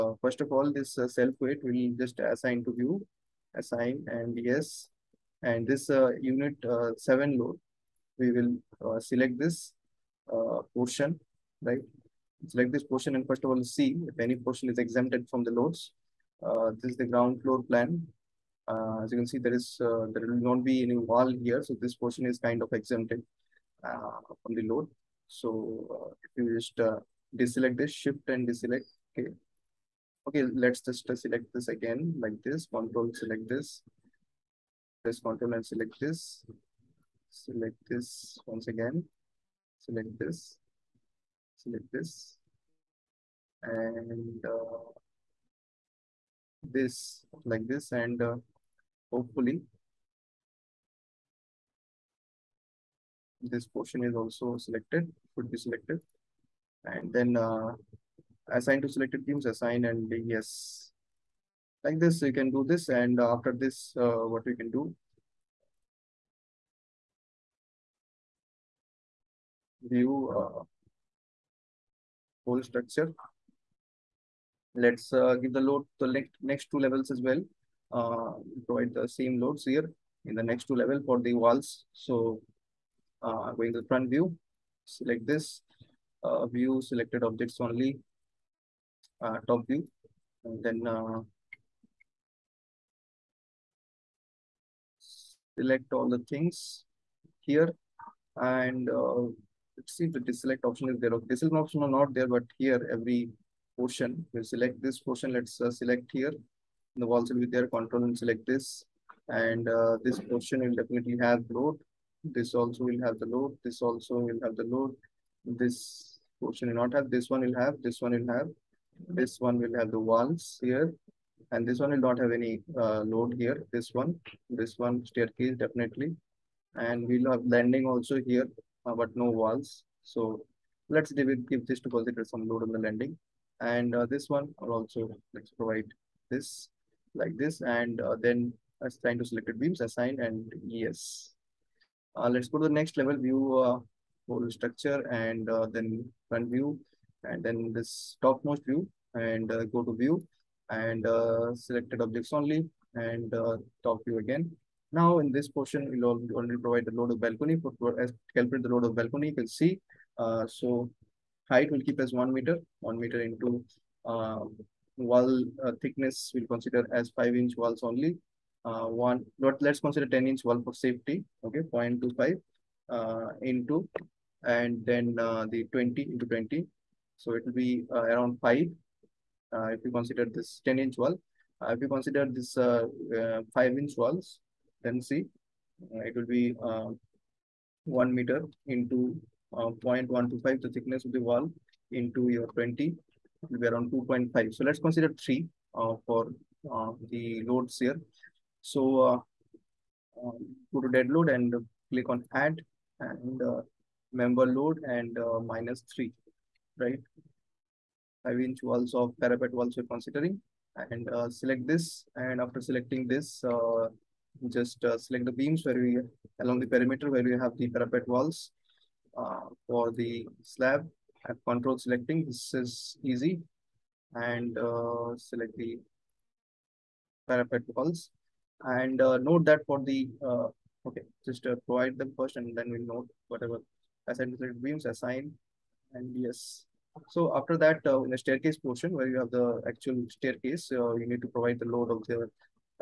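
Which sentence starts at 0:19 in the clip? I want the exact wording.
as you can see, there is there will not be any wall here.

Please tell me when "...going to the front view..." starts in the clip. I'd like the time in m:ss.
1:23.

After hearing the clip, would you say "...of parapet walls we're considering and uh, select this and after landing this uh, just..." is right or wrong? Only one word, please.
wrong.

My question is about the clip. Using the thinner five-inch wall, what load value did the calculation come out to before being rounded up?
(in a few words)
2.5.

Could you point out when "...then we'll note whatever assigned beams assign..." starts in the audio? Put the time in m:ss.
3:52.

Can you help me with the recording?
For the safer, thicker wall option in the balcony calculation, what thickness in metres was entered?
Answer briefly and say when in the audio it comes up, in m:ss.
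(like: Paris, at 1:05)
0.25, at 2:51.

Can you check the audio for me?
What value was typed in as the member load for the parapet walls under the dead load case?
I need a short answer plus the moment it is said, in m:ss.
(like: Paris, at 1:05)
-3, at 3:25.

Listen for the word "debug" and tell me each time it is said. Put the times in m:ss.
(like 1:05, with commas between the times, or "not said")
not said.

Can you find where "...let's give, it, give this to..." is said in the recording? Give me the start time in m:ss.
2:10.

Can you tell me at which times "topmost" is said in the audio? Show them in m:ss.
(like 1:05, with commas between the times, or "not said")
2:28.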